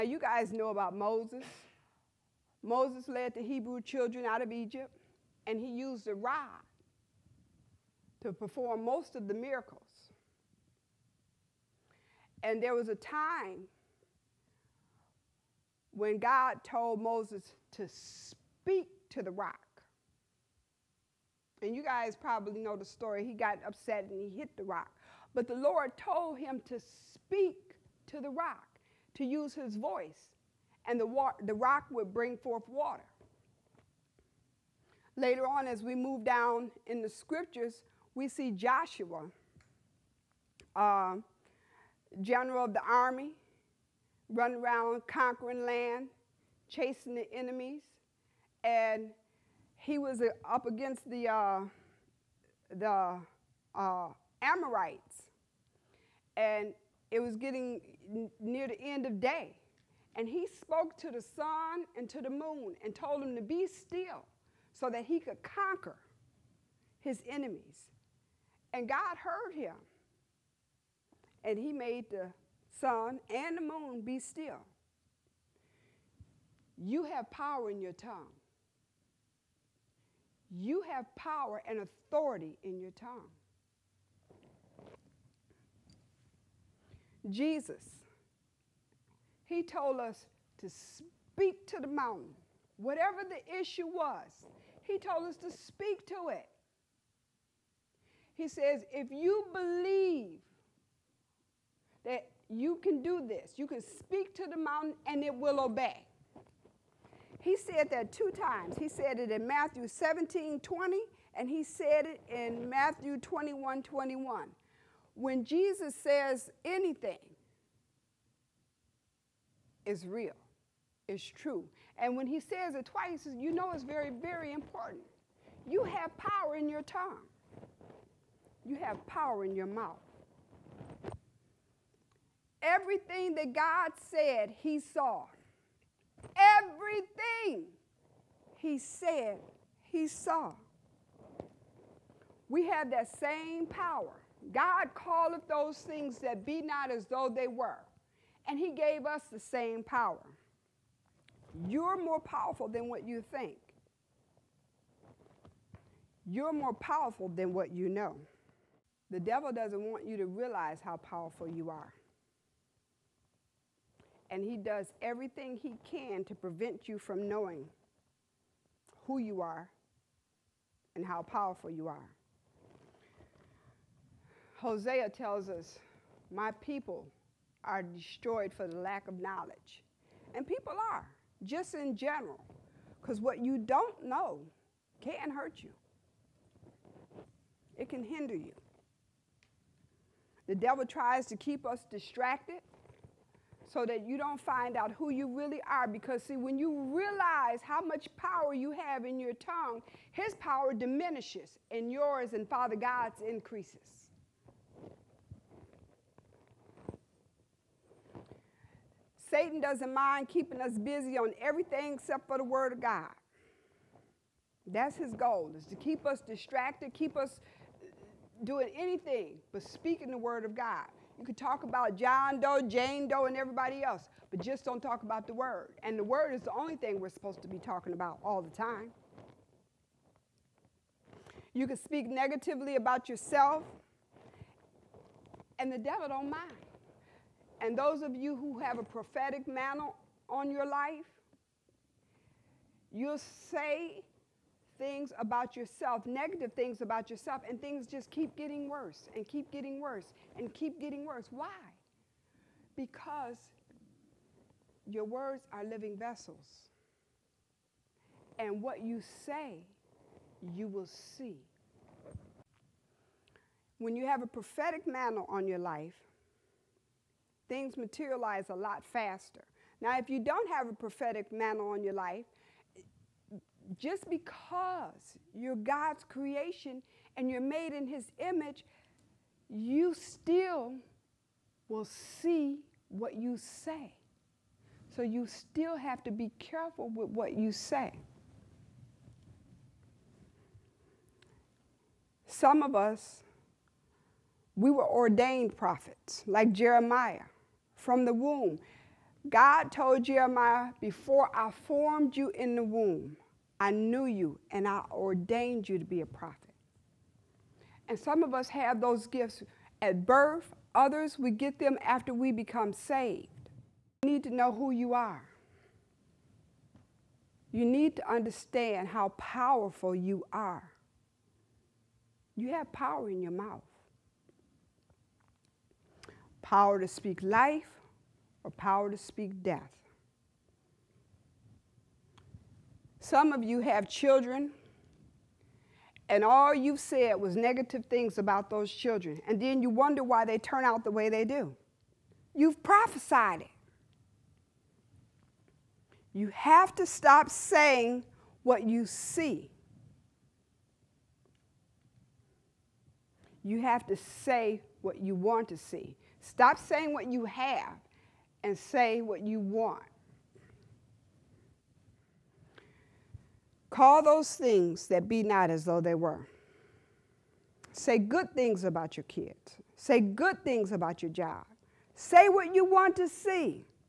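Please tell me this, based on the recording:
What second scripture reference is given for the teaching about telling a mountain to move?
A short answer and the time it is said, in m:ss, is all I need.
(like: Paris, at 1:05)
Matthew 21:21, at 1:52.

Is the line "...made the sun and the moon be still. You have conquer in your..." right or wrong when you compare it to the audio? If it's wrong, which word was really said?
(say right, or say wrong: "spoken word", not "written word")
wrong: "power", not "conquer".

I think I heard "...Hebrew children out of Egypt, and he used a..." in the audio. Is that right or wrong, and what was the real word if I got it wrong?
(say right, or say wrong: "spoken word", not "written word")
right.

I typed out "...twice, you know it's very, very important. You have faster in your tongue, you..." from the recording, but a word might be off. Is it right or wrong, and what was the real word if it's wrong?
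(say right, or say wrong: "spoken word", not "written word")
wrong: "power", not "faster".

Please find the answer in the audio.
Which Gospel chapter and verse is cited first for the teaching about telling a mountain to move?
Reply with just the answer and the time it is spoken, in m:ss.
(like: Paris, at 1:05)
Matthew 17:20, at 1:49.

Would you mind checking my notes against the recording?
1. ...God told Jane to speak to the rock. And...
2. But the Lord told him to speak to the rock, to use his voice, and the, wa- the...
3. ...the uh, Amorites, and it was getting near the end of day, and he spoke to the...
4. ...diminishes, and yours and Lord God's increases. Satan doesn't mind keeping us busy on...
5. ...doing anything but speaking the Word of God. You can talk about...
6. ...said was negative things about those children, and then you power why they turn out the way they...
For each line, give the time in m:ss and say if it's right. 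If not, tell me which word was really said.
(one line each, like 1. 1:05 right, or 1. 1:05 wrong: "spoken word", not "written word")
1. 0:16 wrong: "Moses", not "Jane"
2. 0:25 right
3. 0:52 right
4. 3:20 wrong: "Father", not "Lord"
5. 3:38 right
6. 5:36 wrong: "wonder", not "power".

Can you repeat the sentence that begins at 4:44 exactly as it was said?
So you still have to be careful with what you say.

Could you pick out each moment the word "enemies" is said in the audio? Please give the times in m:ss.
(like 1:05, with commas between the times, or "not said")
0:47, 1:07.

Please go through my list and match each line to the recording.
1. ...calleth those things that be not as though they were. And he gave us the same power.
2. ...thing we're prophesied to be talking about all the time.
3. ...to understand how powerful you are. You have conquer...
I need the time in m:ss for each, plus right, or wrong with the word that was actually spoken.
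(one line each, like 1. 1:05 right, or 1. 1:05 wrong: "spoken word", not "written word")
1. 2:24 right
2. 3:46 wrong: "supposed", not "prophesied"
3. 5:17 wrong: "power", not "conquer".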